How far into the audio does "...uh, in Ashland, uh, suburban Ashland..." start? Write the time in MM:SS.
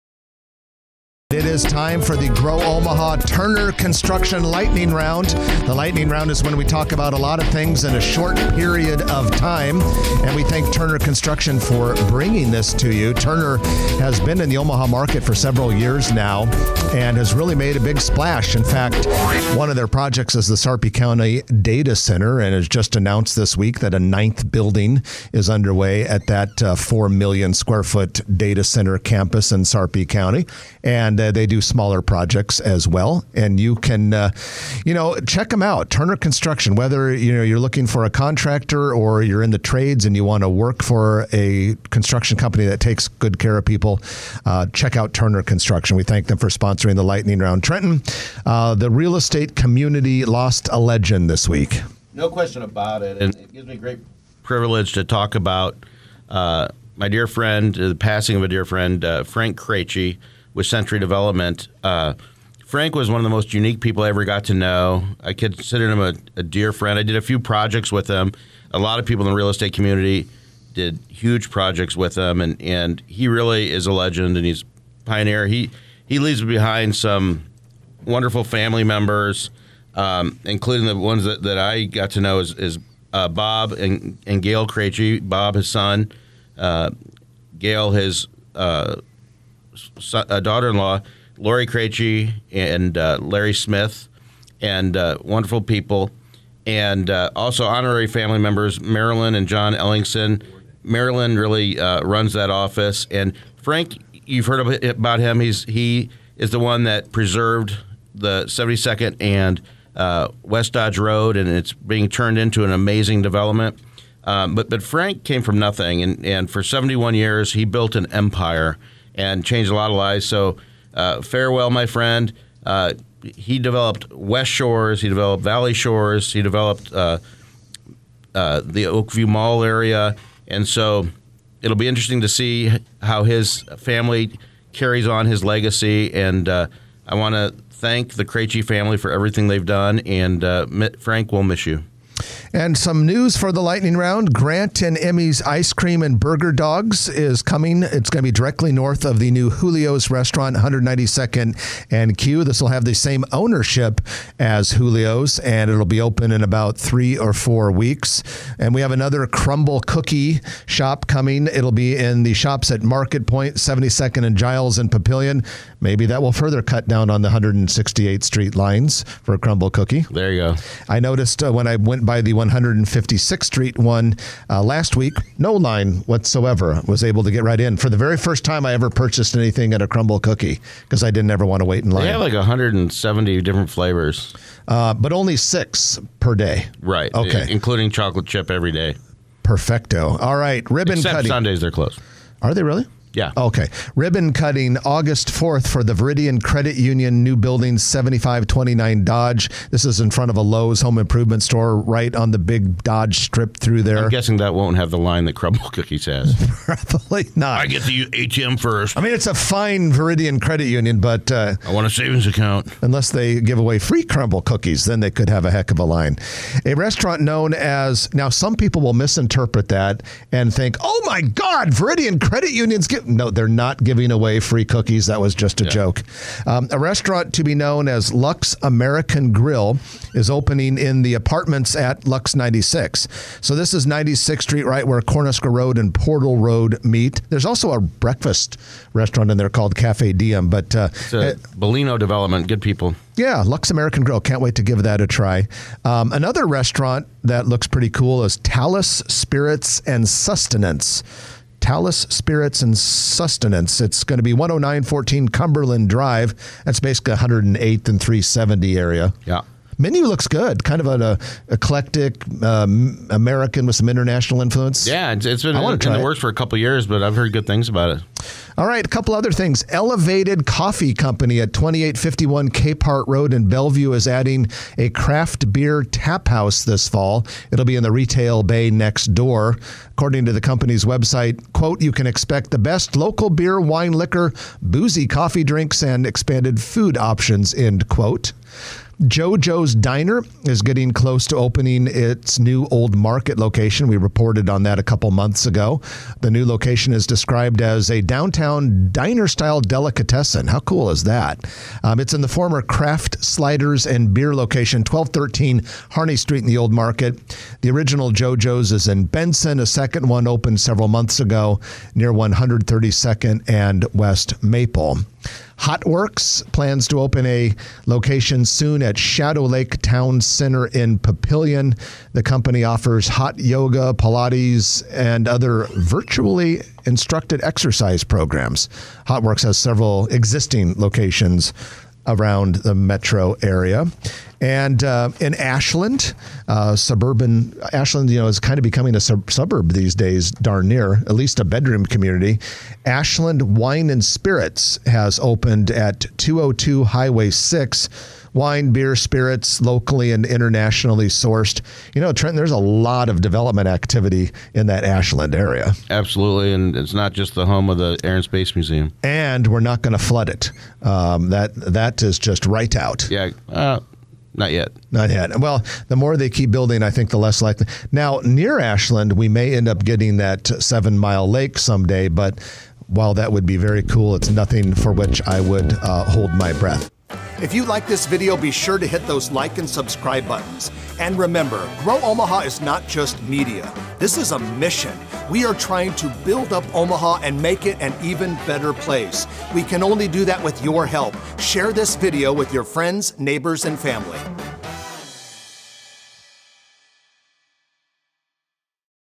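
05:34.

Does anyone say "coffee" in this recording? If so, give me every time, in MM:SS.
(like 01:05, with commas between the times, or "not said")
04:30, 04:45.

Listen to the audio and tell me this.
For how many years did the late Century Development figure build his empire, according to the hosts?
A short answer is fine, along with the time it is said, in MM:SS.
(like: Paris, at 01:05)
71, at 01:56.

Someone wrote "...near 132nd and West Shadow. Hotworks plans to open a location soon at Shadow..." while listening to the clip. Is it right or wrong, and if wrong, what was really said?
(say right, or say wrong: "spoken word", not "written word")
wrong: "Maple", not "Shadow".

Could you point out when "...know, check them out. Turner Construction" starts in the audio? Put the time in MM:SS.
00:34.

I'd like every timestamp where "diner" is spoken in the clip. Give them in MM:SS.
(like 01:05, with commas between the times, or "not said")
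04:49, 04:58.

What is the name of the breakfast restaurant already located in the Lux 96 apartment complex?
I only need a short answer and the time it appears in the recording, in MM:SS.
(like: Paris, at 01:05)
Cafe Diem, at 03:59.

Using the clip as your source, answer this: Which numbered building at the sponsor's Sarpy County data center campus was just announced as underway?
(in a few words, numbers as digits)
9th.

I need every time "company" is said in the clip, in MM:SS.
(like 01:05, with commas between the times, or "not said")
00:42, 04:30, 04:40, 05:22.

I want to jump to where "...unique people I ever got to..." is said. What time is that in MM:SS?
01:03.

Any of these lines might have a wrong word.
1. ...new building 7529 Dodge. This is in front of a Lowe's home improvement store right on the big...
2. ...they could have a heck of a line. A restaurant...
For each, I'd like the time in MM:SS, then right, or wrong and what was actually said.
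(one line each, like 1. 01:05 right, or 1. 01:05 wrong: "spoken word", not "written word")
1. 03:17 right
2. 03:35 right.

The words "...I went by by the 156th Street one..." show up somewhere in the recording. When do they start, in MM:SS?
02:51.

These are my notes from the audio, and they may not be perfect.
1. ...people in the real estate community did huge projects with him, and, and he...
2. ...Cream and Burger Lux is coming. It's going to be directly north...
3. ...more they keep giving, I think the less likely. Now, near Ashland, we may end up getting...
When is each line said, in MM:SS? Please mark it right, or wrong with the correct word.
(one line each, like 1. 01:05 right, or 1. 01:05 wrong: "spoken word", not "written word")
1. 01:09 right
2. 02:25 wrong: "Dogs", not "Lux"
3. 06:05 wrong: "building", not "giving".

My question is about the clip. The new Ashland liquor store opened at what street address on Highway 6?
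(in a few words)
202.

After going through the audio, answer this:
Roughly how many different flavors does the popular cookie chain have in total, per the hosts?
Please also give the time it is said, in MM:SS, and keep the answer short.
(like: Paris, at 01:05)
170, at 03:02.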